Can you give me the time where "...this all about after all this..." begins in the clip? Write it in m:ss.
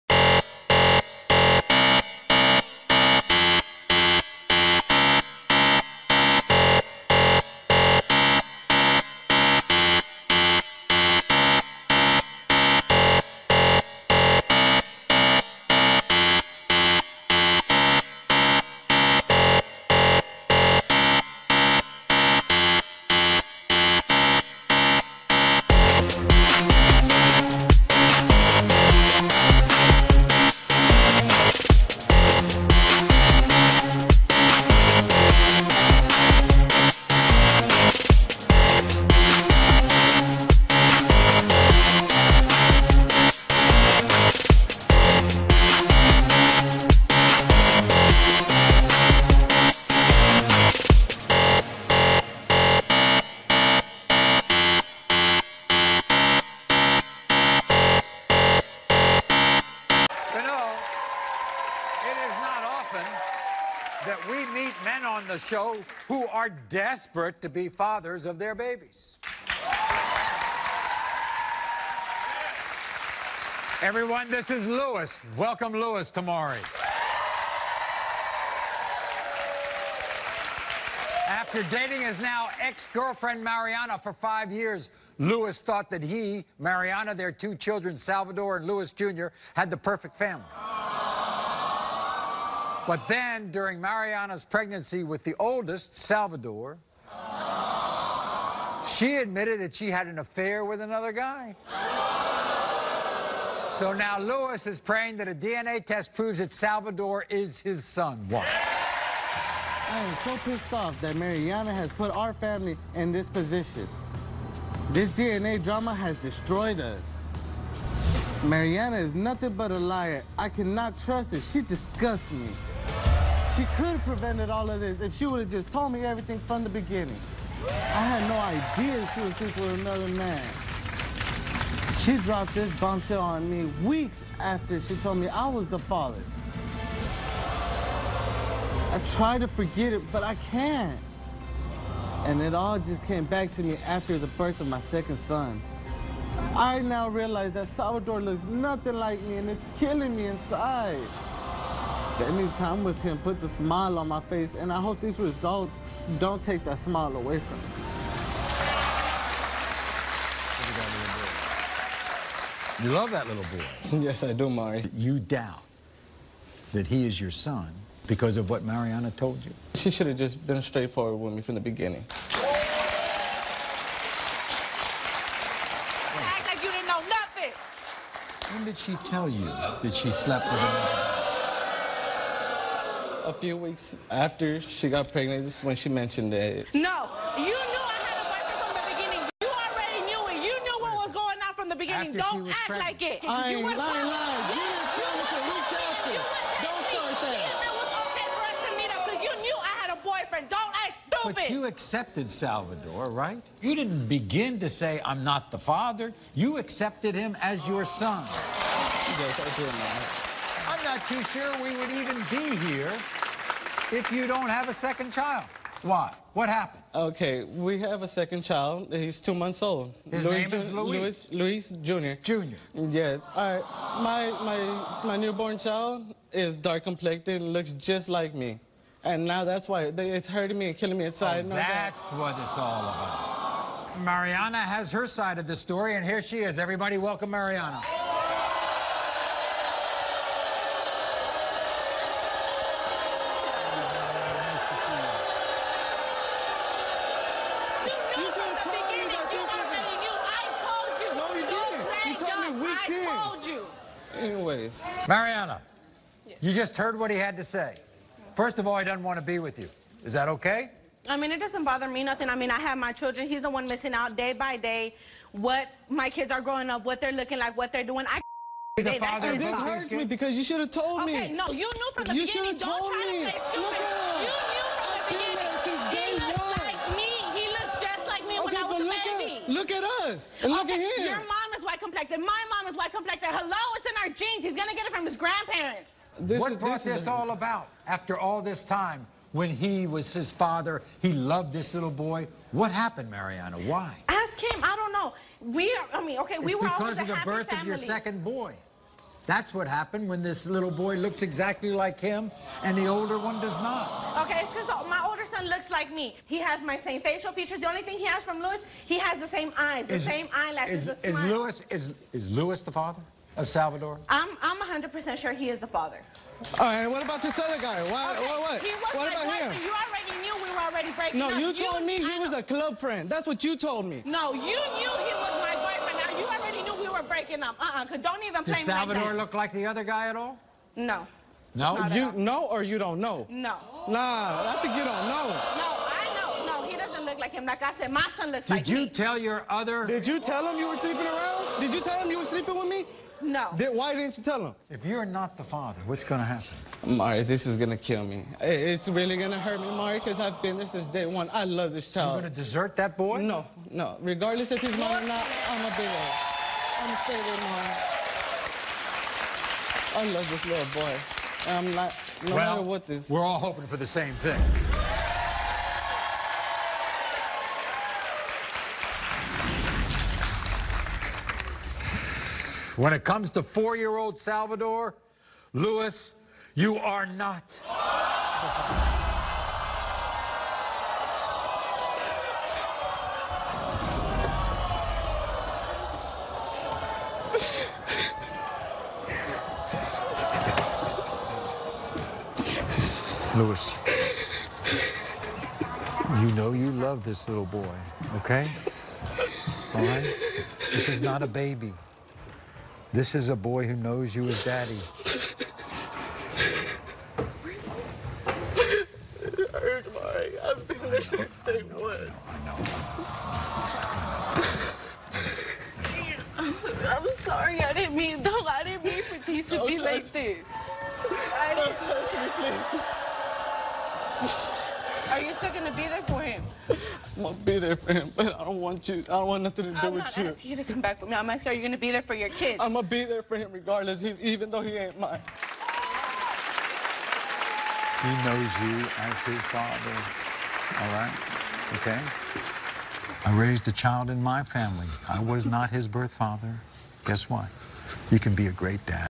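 4:47.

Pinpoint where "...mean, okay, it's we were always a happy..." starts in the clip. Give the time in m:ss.
4:56.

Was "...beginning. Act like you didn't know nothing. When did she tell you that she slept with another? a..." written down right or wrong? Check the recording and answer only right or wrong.
right.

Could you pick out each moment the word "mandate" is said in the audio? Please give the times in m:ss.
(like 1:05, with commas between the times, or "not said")
not said.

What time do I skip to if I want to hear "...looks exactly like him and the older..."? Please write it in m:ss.
5:00.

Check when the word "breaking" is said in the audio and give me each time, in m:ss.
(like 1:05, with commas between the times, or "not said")
5:20, 5:27.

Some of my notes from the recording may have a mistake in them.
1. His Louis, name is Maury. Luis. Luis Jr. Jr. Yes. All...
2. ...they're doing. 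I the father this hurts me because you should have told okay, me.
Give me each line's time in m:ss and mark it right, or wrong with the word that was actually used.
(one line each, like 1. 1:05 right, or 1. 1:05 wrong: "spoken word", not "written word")
1. 3:40 wrong: "Luis", not "Maury"
2. 4:27 right.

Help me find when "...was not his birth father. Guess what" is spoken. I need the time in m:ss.
7:25.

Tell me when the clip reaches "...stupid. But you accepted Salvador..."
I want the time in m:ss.
3:21.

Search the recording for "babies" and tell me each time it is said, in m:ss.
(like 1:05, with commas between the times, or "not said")
1:08.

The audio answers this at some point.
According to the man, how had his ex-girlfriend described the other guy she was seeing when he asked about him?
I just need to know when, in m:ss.
5:22.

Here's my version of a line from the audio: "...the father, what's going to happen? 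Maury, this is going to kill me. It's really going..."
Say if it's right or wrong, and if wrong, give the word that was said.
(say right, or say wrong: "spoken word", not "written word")
right.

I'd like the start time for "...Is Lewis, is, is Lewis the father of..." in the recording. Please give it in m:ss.
5:11.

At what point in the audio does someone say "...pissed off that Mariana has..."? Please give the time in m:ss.
1:50.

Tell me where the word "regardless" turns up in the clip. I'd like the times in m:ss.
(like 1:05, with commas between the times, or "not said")
5:54, 7:13.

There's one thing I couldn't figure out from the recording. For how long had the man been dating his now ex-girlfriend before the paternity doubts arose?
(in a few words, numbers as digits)
5 years.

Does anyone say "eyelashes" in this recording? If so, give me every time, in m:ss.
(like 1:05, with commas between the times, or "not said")
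5:10.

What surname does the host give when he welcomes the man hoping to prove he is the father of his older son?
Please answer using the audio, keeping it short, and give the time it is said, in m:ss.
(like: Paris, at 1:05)
Tamari, at 1:16.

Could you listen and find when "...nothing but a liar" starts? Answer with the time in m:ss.
1:59.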